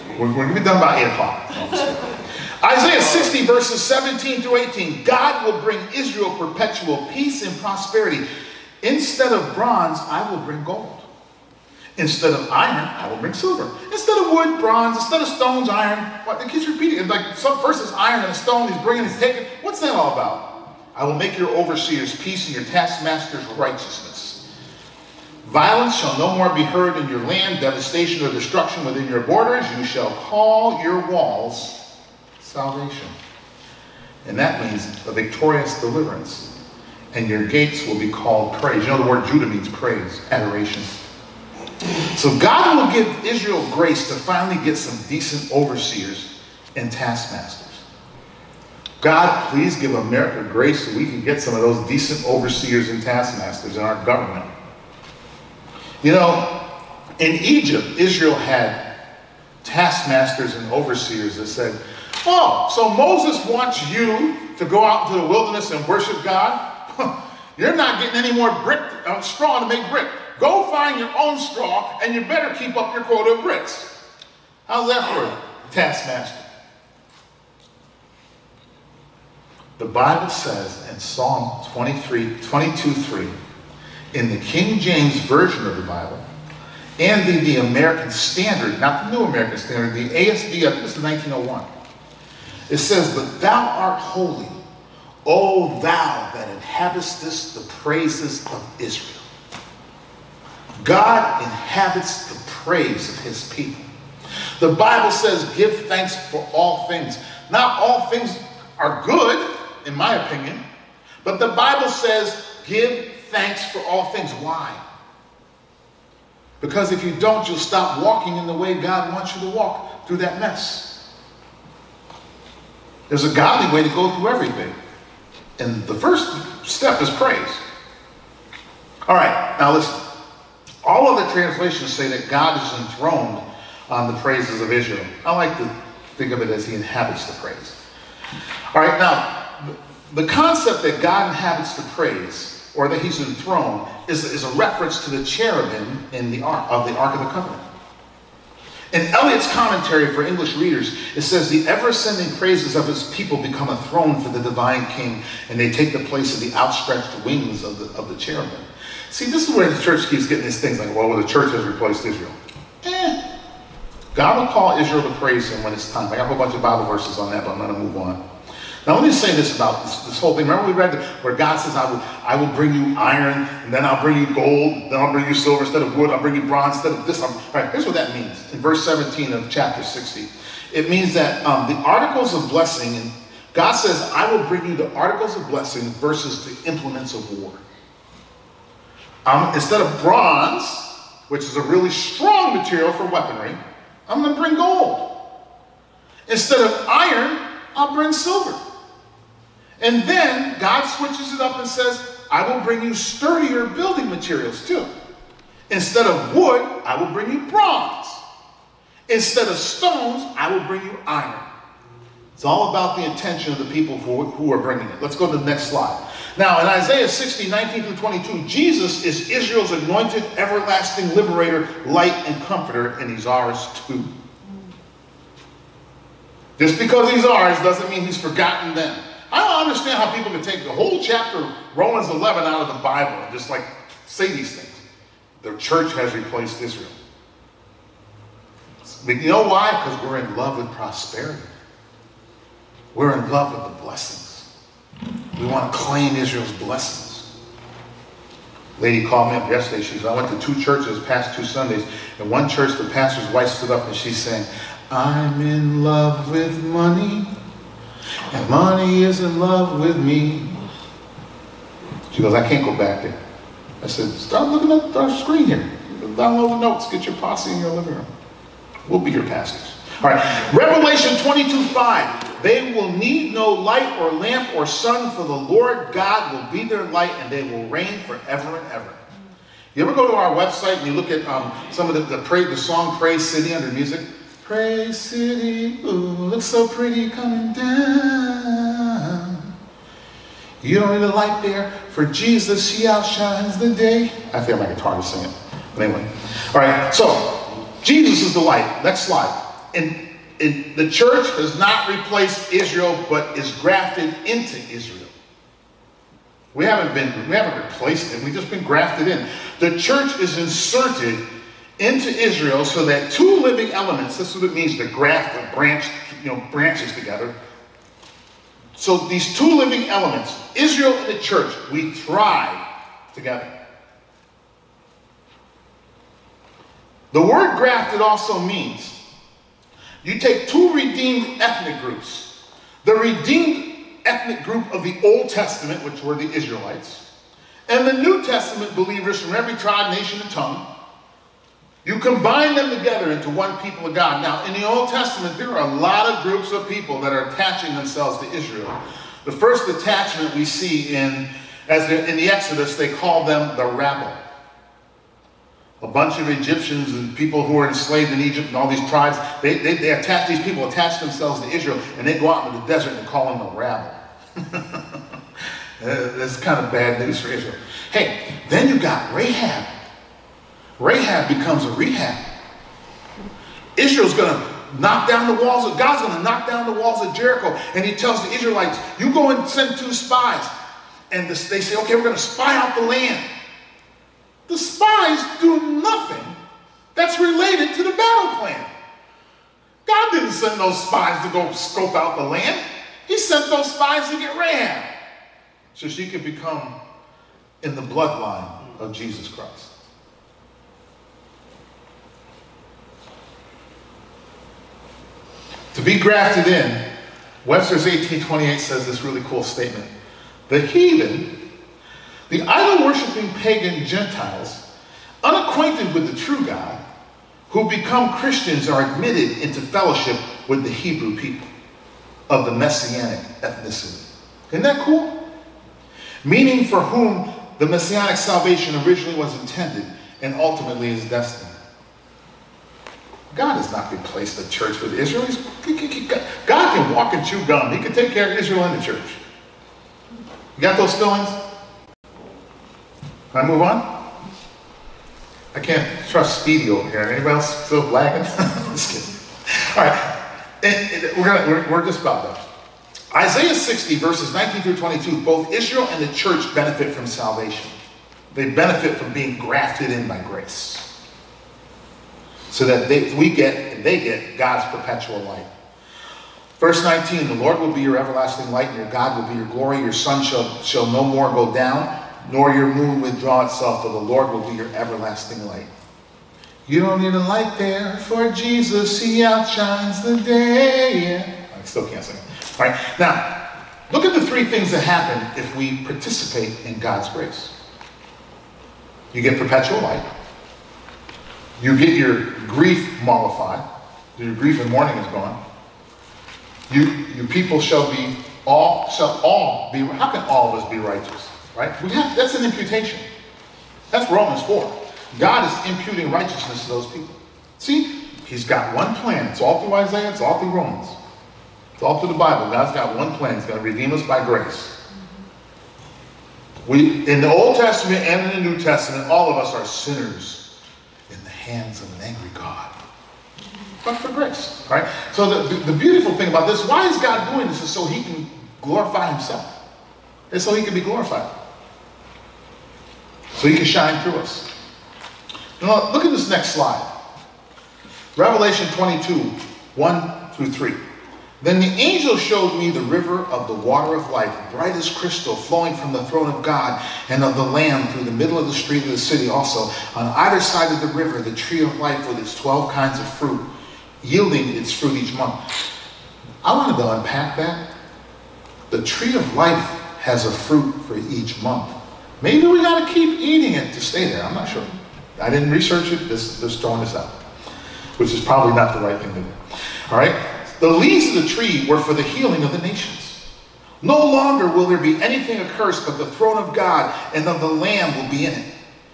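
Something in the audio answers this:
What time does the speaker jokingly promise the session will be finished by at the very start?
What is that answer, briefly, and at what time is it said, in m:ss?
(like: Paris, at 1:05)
8 o'clock, at 0:01.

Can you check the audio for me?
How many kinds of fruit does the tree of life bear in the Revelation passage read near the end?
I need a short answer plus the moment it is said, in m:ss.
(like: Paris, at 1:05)
12, at 9:12.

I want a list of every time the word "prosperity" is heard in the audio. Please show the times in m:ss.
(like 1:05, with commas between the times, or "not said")
0:07, 4:00.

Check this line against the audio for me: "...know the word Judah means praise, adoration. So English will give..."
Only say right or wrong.
wrong.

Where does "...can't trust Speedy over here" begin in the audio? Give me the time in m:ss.
7:25.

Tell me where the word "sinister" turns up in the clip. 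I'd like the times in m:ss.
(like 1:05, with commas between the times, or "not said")
not said.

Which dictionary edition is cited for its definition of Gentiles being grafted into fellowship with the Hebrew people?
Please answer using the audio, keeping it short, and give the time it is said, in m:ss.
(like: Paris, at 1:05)
Webster's 1828, at 6:47.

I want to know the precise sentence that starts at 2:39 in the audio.
See, this is where the church keeps getting these things like, well, the church has replaced Israel.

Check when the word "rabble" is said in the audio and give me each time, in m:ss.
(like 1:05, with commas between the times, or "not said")
5:53, 6:03.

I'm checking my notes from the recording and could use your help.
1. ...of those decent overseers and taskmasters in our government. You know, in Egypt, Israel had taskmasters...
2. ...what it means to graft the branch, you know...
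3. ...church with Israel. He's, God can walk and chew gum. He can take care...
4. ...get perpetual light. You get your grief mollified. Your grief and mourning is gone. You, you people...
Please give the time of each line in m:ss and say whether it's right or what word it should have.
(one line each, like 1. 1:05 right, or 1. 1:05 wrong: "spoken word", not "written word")
1. 0:51 right
2. 5:14 right
3. 7:14 right
4. 8:09 right.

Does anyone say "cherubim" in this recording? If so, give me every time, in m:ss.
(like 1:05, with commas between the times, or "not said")
2:25, 2:38.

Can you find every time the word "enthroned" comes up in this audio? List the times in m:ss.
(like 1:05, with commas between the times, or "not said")
2:12, 2:23.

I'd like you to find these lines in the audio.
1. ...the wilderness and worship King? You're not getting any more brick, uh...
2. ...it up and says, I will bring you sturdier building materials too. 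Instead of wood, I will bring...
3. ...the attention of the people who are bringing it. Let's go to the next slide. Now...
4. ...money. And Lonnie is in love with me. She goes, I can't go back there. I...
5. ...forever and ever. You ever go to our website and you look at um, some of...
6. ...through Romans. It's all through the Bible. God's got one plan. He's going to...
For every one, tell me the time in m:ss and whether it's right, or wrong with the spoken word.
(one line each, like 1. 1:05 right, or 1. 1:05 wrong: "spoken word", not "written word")
1. 1:05 wrong: "God", not "King"
2. 3:21 right
3. 3:32 right
4. 4:16 right
5. 4:38 right
6. 8:30 right.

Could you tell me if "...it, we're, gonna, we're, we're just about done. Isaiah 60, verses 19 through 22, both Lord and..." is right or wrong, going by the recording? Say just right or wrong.
wrong.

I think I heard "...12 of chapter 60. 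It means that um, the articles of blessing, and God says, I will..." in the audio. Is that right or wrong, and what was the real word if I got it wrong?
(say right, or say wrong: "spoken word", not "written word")
wrong: "17", not "12".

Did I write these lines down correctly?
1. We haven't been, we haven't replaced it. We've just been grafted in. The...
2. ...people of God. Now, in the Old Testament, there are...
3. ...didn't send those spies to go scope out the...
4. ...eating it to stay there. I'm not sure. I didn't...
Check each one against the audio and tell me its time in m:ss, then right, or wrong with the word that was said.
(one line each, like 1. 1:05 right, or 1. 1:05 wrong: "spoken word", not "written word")
1. 5:06 right
2. 5:43 right
3. 6:30 right
4. 9:23 right.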